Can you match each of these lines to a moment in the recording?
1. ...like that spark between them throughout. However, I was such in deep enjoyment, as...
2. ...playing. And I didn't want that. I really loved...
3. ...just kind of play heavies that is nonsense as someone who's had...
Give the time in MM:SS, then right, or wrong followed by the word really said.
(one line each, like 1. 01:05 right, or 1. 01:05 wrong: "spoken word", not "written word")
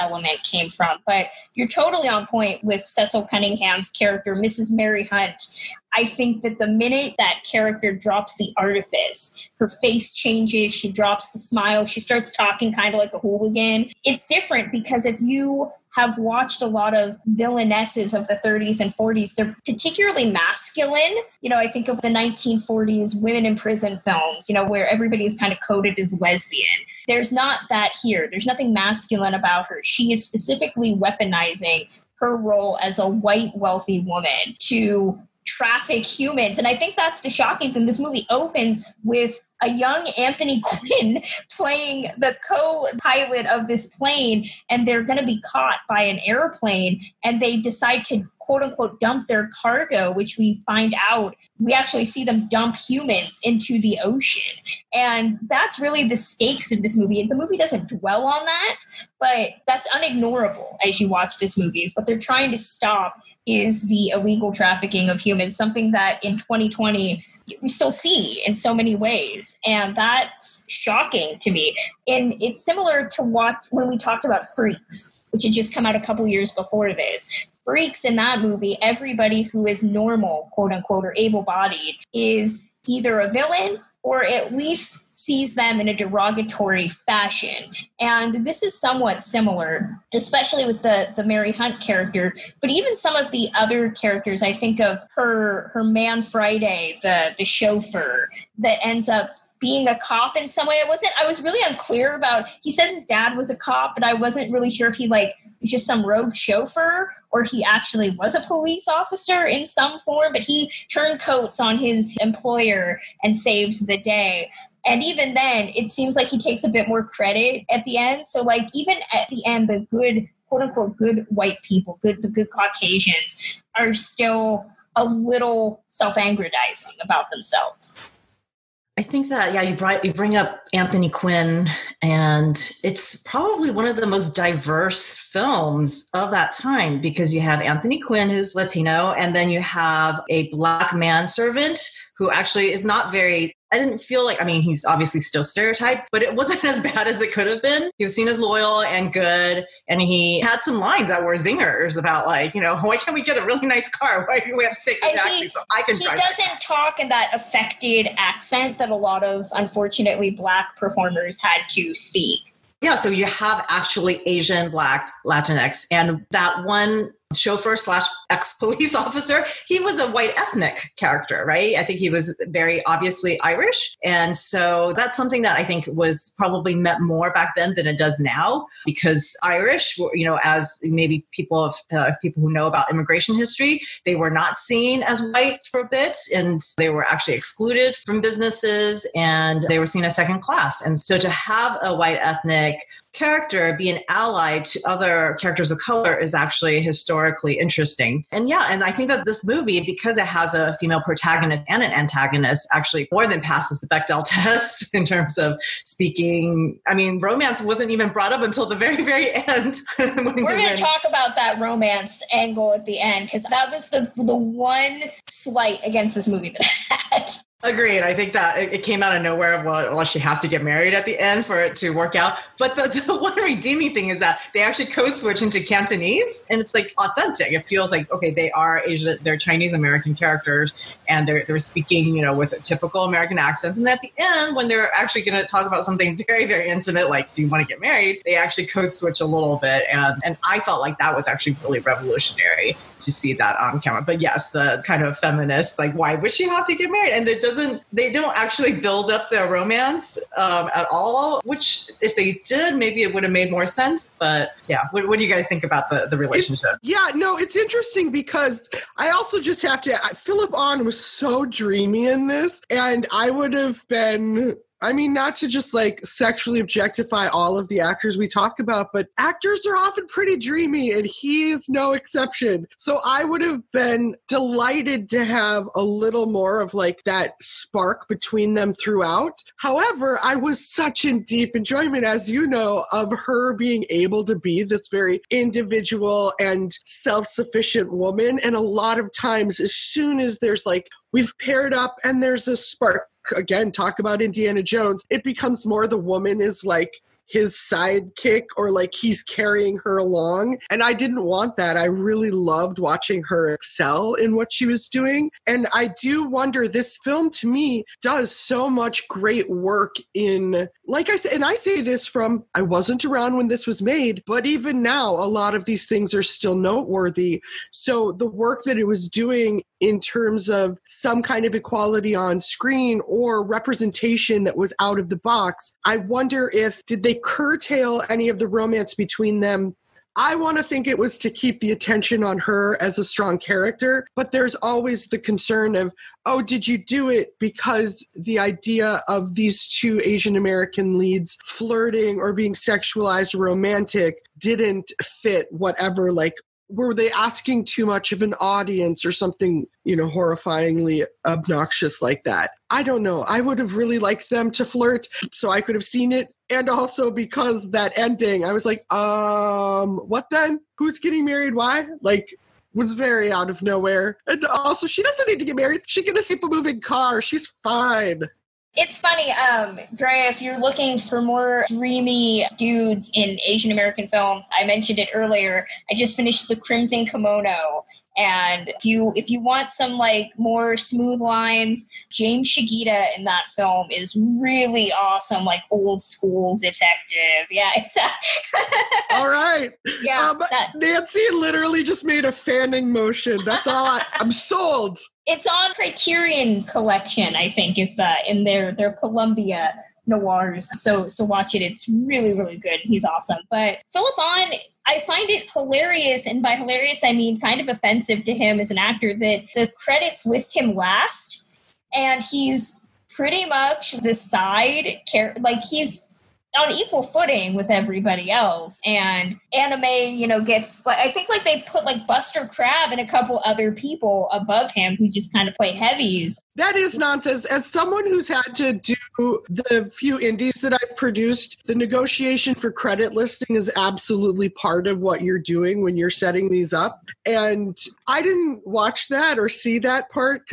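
1. 04:36 right
2. 04:59 wrong: "along", not "playing"
3. 07:05 right.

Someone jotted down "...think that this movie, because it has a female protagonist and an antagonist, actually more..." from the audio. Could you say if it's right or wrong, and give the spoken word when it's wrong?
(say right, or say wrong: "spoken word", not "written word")
right.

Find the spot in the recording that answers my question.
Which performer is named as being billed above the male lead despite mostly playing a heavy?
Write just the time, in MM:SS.
07:02.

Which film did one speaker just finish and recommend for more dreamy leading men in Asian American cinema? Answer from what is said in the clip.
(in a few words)
The Crimson Kimono.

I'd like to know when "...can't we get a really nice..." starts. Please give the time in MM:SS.
02:32.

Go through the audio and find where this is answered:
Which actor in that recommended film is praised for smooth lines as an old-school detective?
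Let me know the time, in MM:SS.
06:22.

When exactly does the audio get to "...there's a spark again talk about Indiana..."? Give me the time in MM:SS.
04:52.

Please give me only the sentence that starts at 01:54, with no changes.
And even then, it seems like he takes a bit more credit at the end.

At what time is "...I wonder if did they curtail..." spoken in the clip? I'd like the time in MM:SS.
05:25.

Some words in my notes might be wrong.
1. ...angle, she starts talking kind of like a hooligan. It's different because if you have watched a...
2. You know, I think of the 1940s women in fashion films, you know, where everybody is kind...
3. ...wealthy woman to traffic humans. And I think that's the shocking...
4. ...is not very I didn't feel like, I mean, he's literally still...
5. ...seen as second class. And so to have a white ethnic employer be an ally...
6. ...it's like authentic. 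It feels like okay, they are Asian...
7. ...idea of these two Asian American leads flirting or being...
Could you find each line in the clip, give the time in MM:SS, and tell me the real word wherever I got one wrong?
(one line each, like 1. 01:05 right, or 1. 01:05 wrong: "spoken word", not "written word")
1. 00:11 wrong: "smile", not "angle"
2. 00:21 wrong: "prison", not "fashion"
3. 00:33 right
4. 02:22 wrong: "obviously", not "literally"
5. 03:09 wrong: "character", not "employer"
6. 03:46 right
7. 05:38 right.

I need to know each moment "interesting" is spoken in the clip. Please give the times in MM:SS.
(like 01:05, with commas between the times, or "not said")
03:17, 04:17.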